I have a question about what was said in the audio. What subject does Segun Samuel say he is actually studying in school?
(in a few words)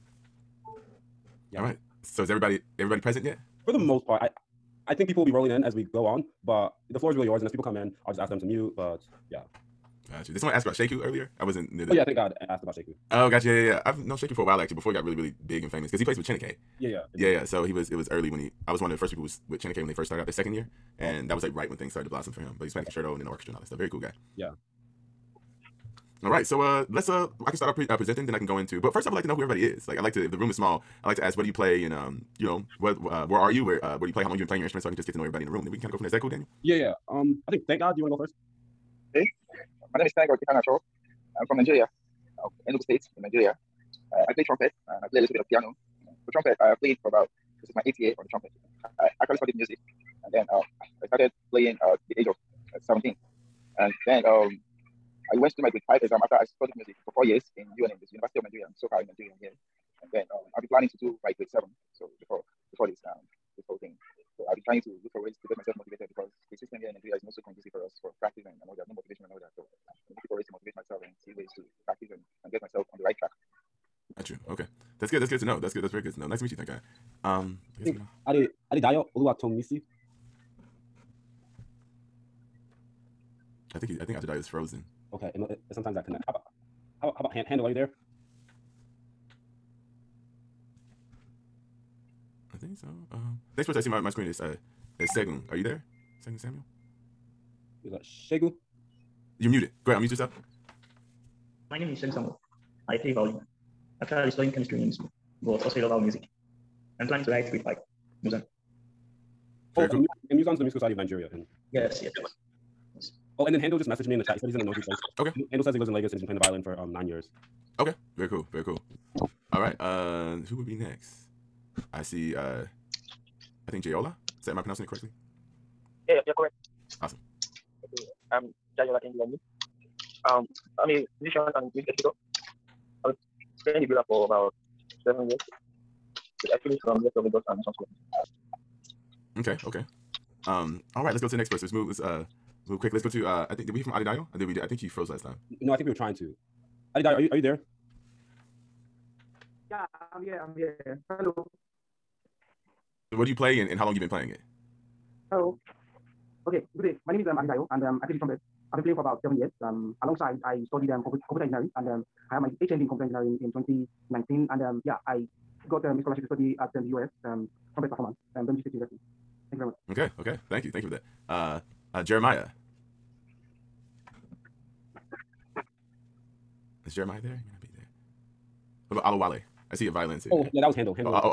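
Chemistry.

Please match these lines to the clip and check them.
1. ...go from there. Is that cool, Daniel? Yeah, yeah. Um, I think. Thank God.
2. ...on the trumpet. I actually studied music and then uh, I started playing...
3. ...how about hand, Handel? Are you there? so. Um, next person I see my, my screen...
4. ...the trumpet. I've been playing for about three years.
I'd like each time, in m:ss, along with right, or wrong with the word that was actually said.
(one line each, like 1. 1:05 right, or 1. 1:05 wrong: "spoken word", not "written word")
1. 0:35 right
2. 0:48 right
3. 1:27 right
4. 2:38 wrong: "seven", not "three".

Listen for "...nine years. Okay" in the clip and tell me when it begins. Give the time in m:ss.
1:56.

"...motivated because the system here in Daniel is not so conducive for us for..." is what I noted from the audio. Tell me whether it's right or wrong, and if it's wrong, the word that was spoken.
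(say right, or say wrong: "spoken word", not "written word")
wrong: "Nigeria", not "Daniel".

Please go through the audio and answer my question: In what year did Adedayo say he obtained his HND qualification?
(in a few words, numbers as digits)
2019.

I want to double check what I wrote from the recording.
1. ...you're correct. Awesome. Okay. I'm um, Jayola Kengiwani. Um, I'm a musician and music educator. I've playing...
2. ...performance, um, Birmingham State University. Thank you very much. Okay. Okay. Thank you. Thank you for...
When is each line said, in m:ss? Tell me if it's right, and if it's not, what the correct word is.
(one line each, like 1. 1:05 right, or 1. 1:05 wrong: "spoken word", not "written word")
1. 2:06 right
2. 2:47 right.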